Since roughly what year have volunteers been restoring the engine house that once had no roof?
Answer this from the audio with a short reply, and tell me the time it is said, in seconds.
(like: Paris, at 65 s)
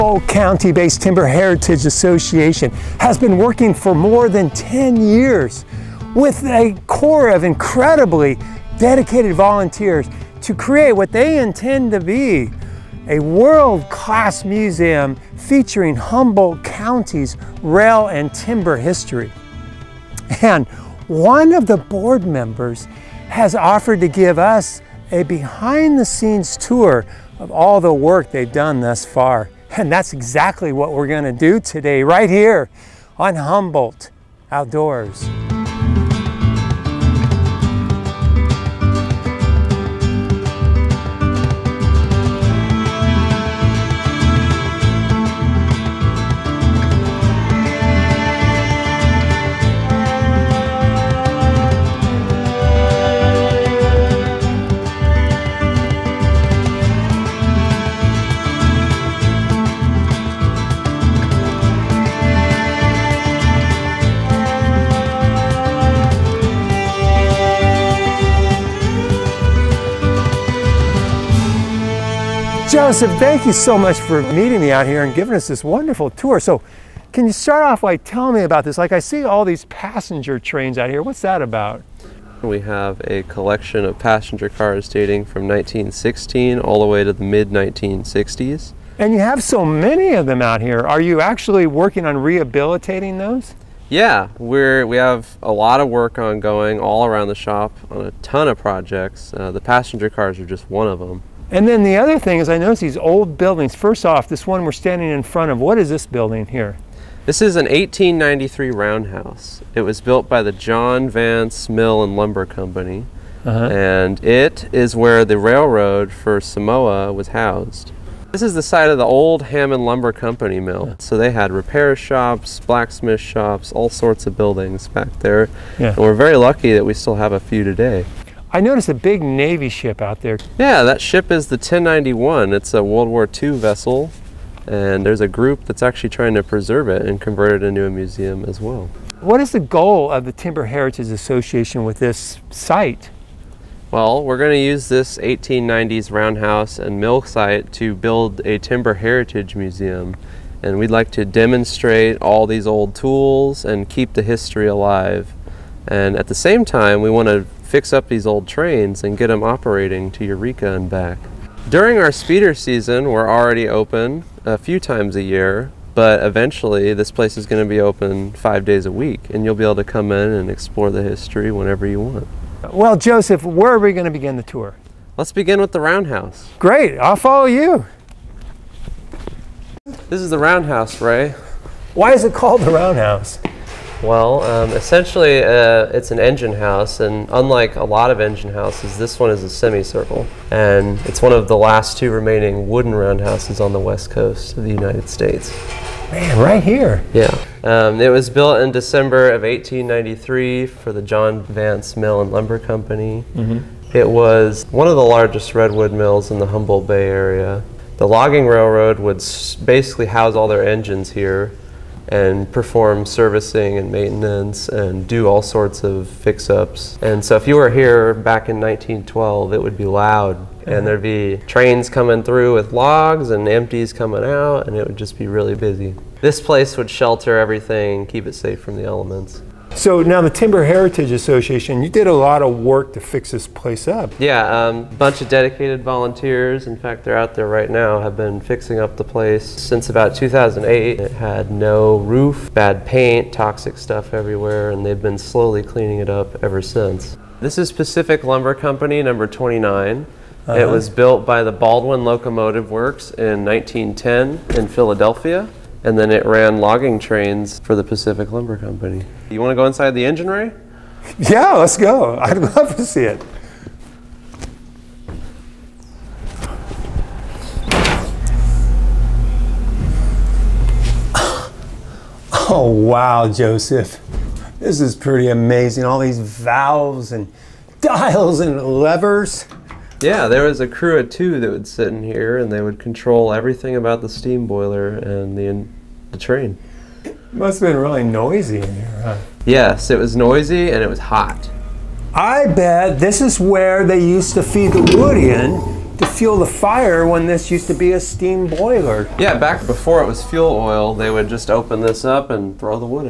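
2008, at 240 s.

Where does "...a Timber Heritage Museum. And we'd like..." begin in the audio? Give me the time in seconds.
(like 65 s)
148 s.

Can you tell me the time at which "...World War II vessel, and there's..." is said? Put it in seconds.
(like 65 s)
132 s.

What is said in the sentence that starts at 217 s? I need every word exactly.
And so if you were here back in 1912, it would be loud.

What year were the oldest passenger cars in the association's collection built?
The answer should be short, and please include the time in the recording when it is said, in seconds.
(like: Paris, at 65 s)
1916, at 85 s.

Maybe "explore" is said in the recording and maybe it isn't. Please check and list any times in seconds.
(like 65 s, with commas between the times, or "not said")
170 s.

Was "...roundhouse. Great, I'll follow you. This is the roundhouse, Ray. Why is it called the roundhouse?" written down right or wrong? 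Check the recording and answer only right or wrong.
right.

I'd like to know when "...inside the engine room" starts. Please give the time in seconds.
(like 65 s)
259 s.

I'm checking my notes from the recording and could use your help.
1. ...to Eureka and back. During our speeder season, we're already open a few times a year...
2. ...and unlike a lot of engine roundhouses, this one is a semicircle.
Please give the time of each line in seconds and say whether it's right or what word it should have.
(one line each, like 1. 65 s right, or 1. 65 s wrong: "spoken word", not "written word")
1. 160 s right
2. 186 s wrong: "houses", not "roundhouses".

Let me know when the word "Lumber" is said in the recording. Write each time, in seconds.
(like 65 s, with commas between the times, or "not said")
112 s, 119 s, 202 s, 248 s, 258 s.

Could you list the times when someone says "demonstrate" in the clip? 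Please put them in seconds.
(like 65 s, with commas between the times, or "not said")
151 s.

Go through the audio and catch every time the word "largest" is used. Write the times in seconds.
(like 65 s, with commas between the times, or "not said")
205 s.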